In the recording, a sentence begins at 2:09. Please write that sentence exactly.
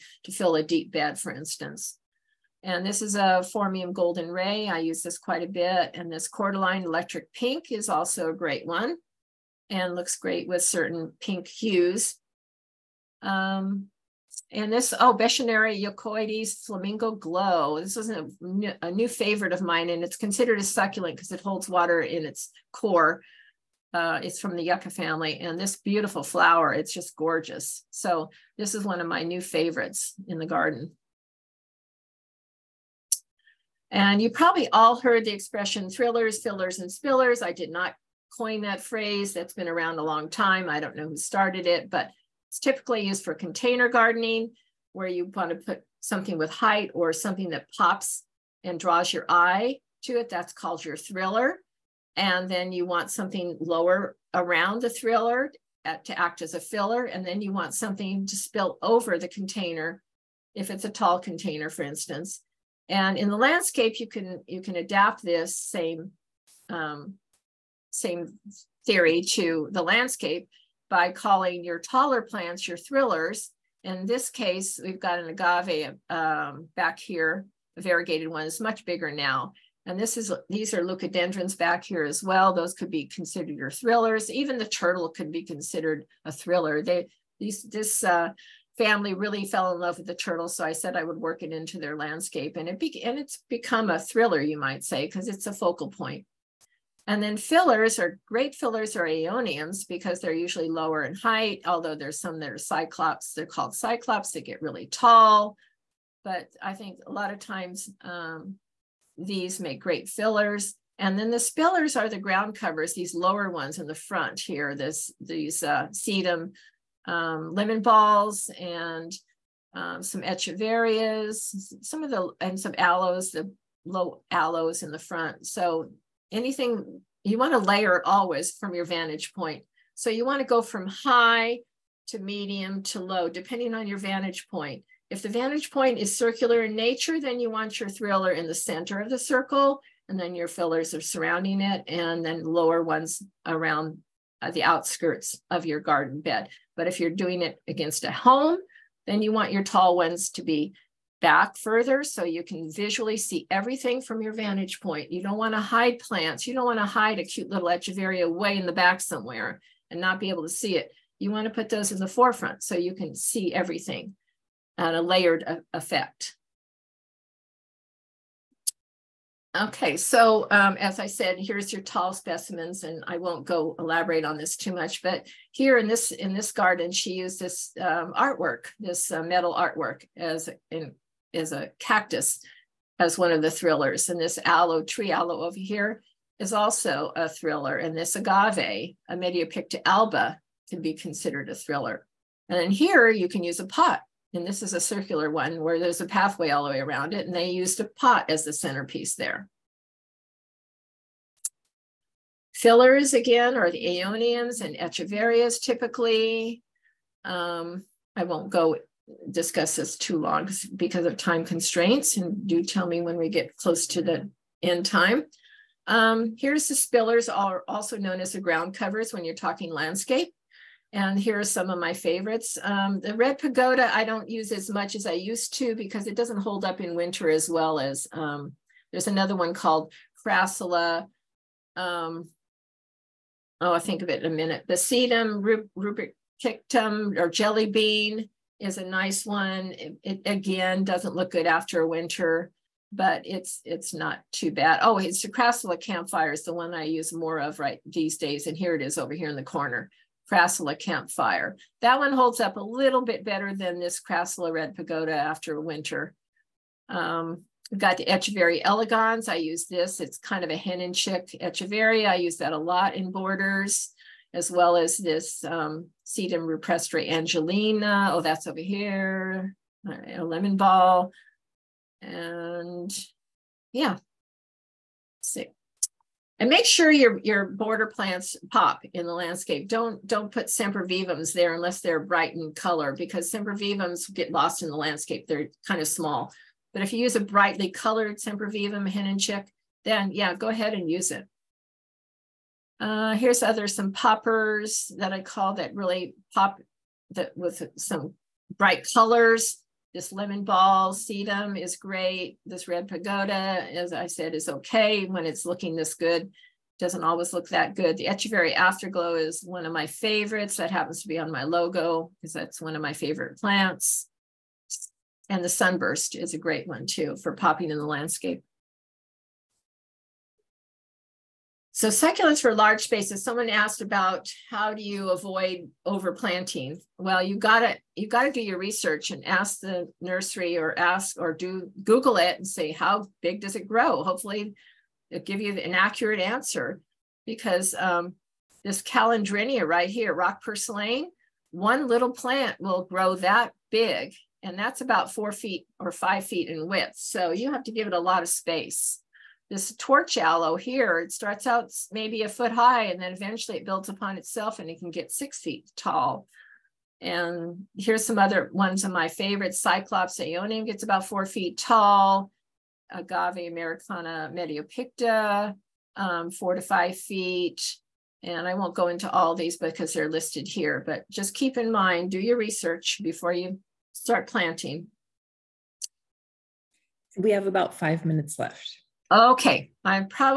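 So you want to go from high to medium to low, depending on your vantage point.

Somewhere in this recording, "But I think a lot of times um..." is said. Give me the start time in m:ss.
1:46.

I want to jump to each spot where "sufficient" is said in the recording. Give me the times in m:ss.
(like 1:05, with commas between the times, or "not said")
not said.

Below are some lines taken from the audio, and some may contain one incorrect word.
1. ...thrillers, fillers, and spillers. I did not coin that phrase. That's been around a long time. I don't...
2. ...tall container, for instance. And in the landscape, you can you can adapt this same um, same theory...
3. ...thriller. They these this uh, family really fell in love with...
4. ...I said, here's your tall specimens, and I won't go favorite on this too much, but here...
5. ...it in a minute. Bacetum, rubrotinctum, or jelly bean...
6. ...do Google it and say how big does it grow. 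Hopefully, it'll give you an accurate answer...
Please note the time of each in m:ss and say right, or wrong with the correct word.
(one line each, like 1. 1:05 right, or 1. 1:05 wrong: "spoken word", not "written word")
1. 0:35 right
2. 1:00 right
3. 1:26 right
4. 2:50 wrong: "elaborate", not "favorite"
5. 3:54 right
6. 5:31 right.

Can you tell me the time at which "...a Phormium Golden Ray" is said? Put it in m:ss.
0:03.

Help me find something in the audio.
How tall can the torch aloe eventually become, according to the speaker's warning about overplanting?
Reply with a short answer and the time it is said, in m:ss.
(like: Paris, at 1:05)
6 feet, at 5:55.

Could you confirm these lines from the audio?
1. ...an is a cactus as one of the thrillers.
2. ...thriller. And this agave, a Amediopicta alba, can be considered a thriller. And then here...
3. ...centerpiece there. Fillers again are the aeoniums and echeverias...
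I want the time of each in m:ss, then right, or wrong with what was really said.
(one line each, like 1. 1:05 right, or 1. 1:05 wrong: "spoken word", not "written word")
1. 3:00 right
2. 3:07 right
3. 3:18 right.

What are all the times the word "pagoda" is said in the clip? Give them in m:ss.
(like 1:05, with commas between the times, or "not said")
3:43, 4:14, 5:02.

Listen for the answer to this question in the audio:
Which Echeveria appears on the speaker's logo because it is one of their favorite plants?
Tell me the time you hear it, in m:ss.
5:08.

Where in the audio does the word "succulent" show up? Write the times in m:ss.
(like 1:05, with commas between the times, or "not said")
0:20, 5:21.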